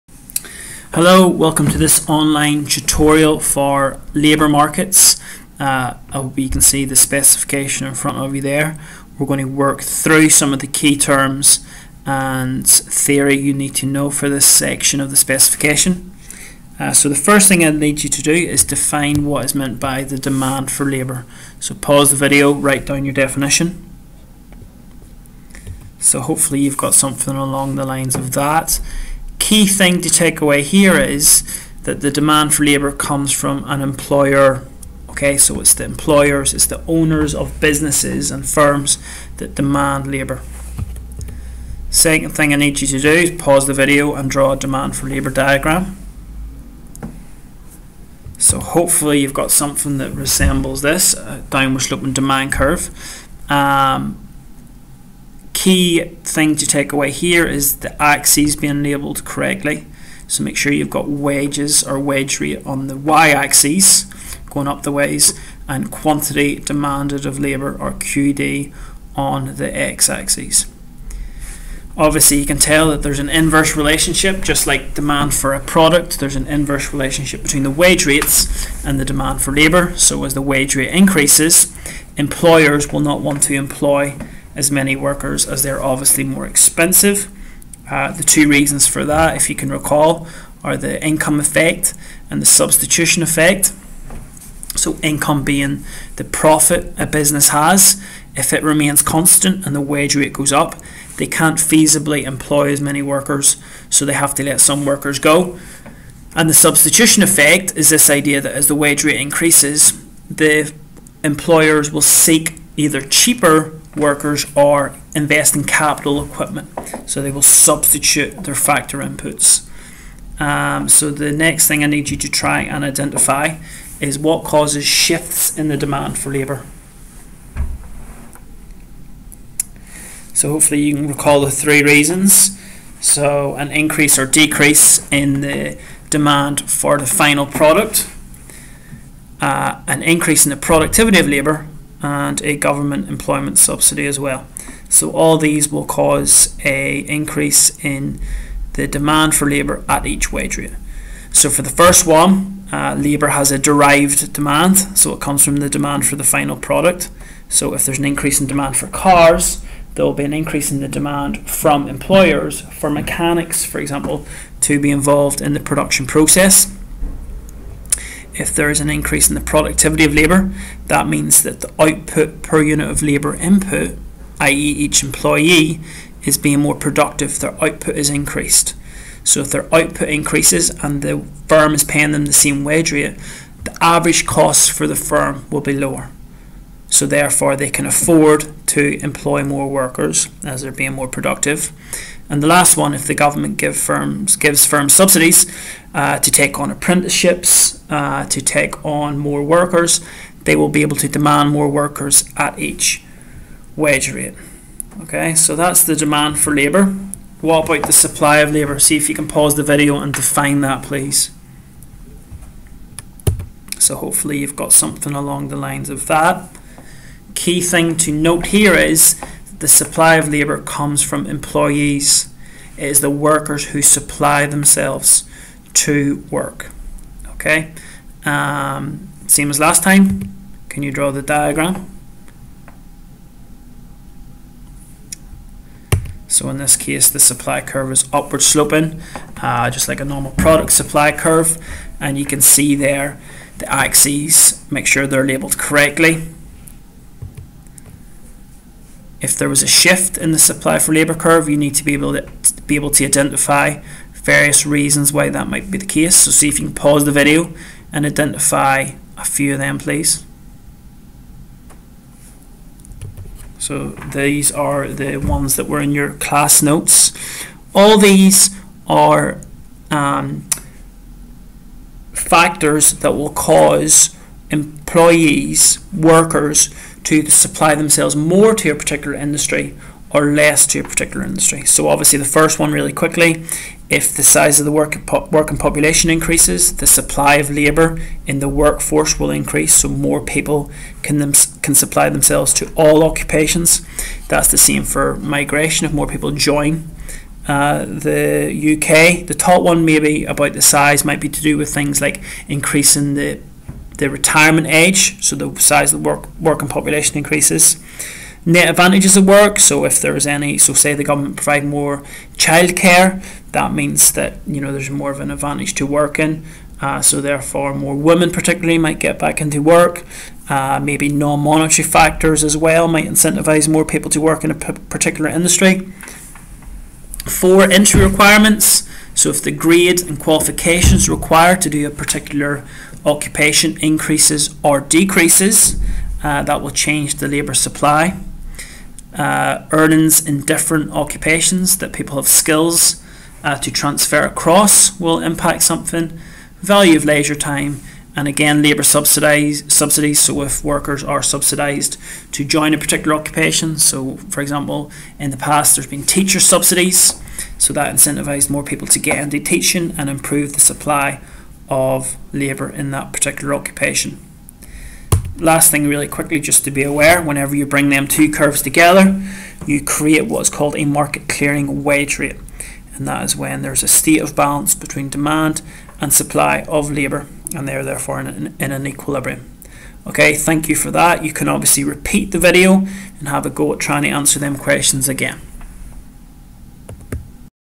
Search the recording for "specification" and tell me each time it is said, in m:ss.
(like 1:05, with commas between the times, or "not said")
0:06, 0:15.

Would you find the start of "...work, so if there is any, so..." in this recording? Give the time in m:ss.
5:09.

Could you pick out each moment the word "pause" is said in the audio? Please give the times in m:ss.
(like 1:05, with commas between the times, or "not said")
0:21, 0:43, 3:29, 4:16.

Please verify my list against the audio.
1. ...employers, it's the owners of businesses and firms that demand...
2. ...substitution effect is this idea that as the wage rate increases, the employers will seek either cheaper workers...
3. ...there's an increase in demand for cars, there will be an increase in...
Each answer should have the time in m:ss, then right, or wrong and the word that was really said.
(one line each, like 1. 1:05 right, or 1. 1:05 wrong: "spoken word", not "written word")
1. 0:35 right
2. 1:46 right
3. 2:37 right.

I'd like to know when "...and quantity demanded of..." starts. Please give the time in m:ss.
1:05.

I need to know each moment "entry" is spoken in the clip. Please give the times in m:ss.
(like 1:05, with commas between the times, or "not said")
5:27.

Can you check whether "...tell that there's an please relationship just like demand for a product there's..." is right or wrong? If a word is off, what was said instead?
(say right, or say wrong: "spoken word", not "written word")
wrong: "inverse", not "please".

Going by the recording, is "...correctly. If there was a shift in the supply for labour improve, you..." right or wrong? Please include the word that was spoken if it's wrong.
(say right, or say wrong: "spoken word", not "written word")
wrong: "curve", not "improve".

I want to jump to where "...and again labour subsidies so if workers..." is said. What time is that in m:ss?
5:48.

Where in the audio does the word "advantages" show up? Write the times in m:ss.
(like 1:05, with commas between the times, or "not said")
5:08, 5:15.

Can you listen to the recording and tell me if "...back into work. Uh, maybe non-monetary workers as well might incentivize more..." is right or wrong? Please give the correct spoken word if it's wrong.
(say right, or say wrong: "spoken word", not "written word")
wrong: "factors", not "workers".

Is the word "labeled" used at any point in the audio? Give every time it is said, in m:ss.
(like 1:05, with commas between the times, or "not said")
0:58, 4:05.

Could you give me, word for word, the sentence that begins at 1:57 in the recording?
So they will substitute their factor inputs.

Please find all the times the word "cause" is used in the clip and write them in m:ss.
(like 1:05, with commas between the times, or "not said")
2:04, 2:25, 4:33.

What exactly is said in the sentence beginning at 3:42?
It is the workers who supply themselves to work.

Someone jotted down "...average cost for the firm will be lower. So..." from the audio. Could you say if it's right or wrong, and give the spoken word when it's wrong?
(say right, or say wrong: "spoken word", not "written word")
right.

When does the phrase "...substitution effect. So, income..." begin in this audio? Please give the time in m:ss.
1:32.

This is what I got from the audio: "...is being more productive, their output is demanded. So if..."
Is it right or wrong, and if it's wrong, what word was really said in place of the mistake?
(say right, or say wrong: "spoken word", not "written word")
wrong: "increased", not "demanded".